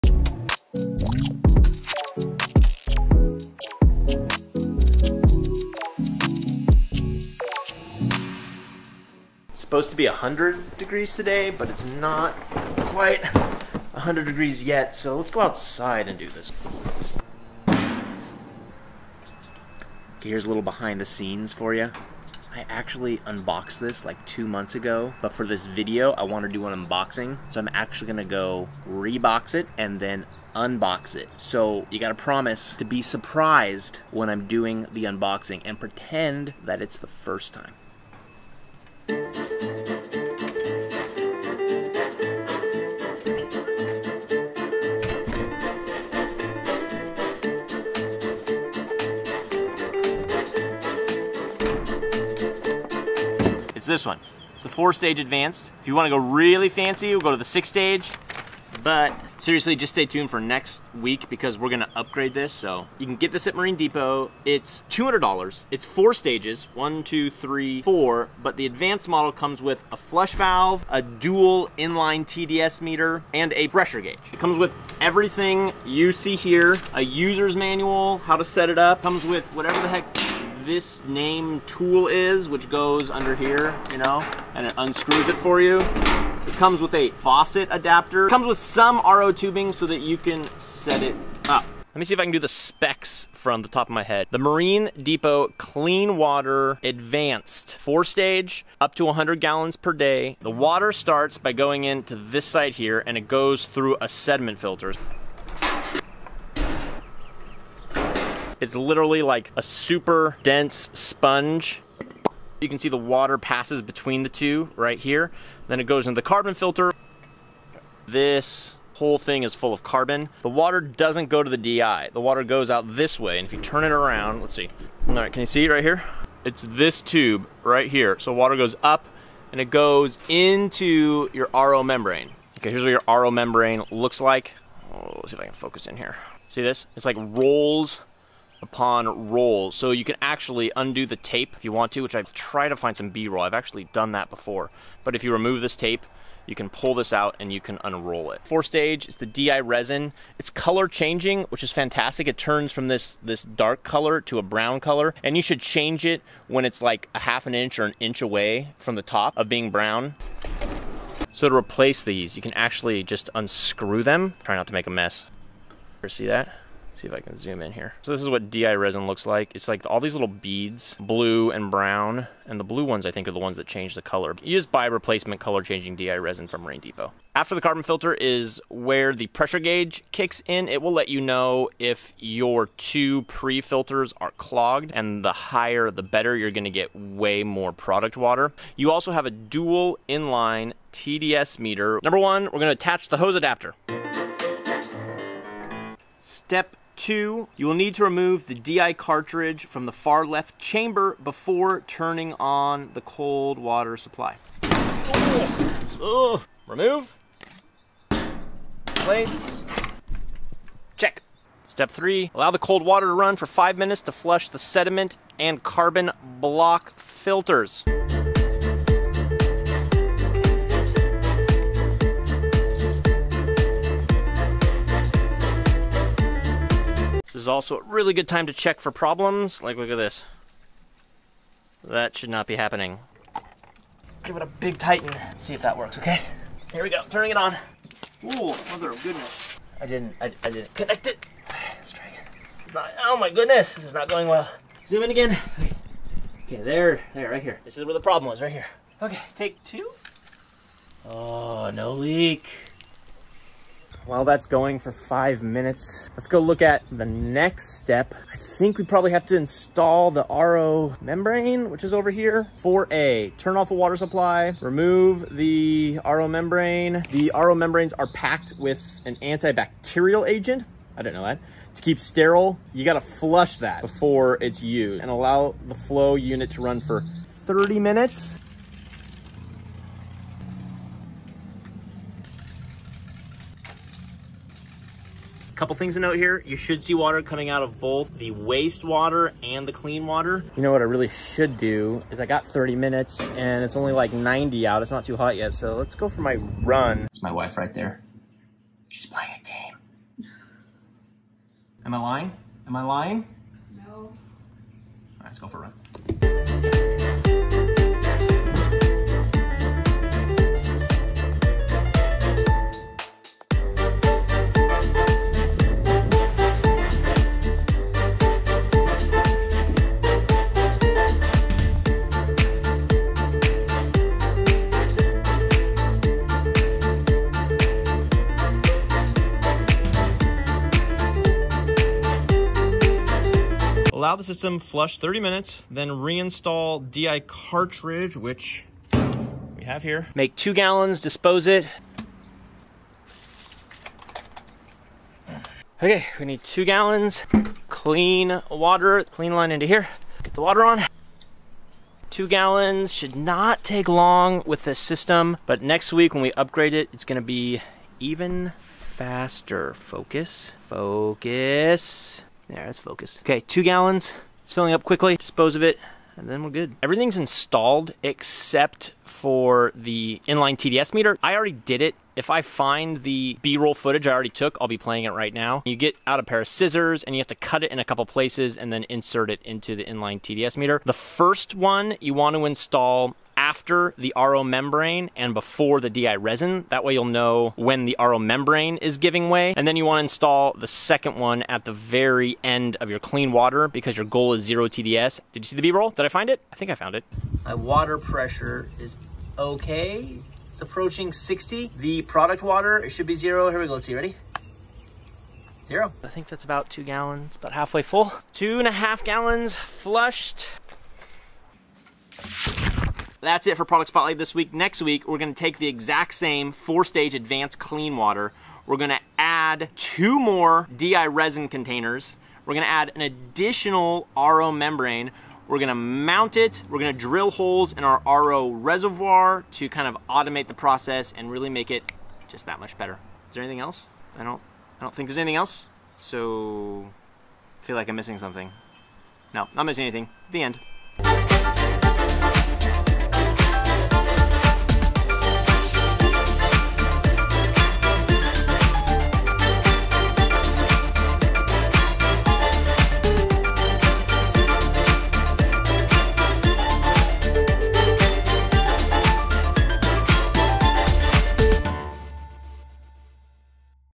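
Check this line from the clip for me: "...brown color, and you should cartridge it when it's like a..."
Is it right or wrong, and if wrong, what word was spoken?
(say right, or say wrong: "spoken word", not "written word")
wrong: "change", not "cartridge".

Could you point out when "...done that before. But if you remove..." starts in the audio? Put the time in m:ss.
2:23.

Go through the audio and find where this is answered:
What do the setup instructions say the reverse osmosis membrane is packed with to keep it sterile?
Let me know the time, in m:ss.
4:29.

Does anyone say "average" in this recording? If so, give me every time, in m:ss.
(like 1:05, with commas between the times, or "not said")
not said.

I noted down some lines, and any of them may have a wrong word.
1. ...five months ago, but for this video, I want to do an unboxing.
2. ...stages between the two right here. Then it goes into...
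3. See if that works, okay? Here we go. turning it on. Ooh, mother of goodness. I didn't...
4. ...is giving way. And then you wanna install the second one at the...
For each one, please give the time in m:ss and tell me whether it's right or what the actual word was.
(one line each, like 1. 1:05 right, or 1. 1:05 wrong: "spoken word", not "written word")
1. 0:24 wrong: "two", not "five"
2. 1:53 wrong: "passes", not "stages"
3. 3:55 right
4. 6:28 right.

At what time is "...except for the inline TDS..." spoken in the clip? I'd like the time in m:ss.
6:08.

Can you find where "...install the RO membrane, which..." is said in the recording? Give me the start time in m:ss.
4:19.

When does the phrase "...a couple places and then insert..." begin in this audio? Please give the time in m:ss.
6:17.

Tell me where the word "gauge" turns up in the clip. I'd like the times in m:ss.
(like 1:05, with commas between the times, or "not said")
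1:14, 2:59.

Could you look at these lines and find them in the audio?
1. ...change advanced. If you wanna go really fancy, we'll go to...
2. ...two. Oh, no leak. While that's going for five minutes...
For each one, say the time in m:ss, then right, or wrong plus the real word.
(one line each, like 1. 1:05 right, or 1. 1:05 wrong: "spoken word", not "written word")
1. 0:54 wrong: "stage", not "change"
2. 4:09 right.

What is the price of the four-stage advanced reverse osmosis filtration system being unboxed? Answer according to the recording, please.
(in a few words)
$200.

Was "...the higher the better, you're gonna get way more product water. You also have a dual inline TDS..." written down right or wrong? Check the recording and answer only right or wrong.
right.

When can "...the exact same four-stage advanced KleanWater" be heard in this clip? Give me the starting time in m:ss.
6:55.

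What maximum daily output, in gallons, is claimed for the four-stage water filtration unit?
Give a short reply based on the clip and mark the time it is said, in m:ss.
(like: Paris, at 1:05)
100 gallons per day, at 1:39.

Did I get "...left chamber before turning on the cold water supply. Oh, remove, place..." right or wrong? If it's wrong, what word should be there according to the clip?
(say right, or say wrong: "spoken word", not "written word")
right.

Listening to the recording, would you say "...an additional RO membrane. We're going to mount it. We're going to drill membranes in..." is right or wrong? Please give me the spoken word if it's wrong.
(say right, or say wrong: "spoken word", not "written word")
wrong: "holes", not "membranes".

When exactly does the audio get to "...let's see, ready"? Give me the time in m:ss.
6:43.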